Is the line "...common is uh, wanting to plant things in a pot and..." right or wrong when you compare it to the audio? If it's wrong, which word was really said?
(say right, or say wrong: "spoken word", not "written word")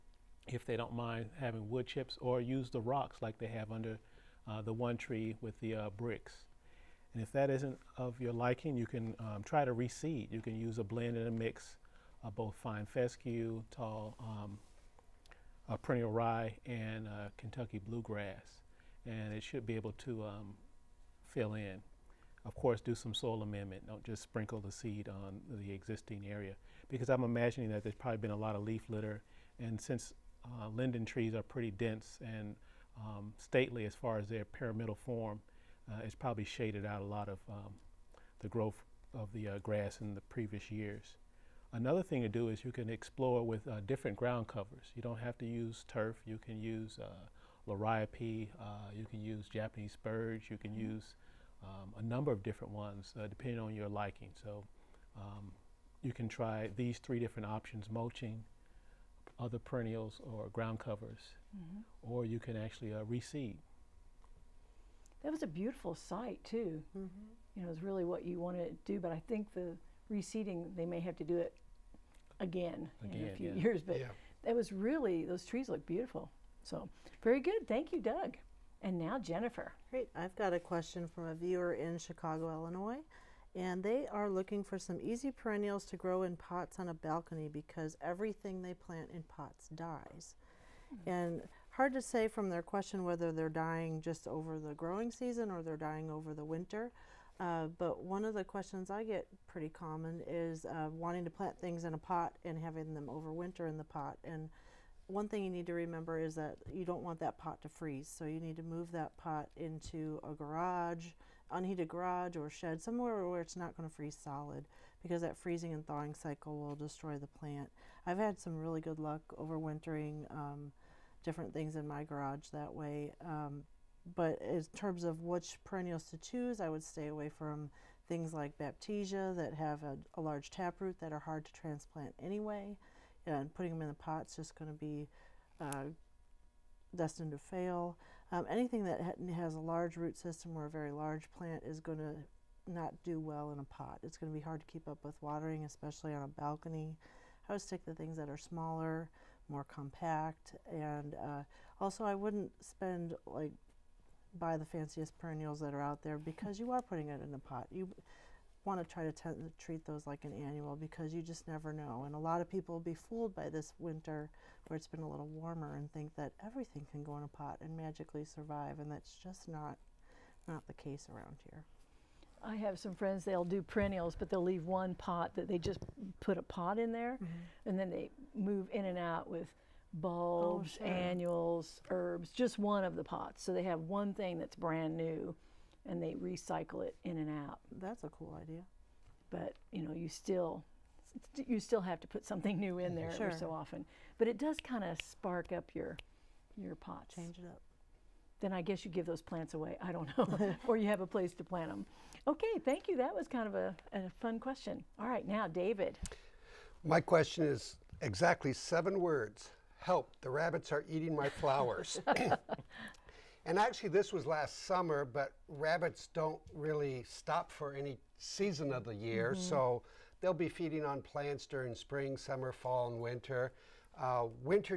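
right.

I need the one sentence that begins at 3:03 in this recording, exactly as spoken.
So they have one thing that's brand new and they recycle it in and out.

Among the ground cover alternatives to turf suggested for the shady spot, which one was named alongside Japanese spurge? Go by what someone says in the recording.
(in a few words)
Liriope.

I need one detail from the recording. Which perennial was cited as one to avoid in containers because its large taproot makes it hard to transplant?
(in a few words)
Baptisia.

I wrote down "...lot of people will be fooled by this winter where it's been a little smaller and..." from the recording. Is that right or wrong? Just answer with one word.
wrong.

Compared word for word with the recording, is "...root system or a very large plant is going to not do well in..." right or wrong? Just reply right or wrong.
right.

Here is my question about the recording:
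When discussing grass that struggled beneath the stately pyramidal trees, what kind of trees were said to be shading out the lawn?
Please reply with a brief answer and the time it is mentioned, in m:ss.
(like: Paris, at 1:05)
Linden trees, at 0:30.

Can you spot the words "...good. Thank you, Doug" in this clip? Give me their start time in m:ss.
1:17.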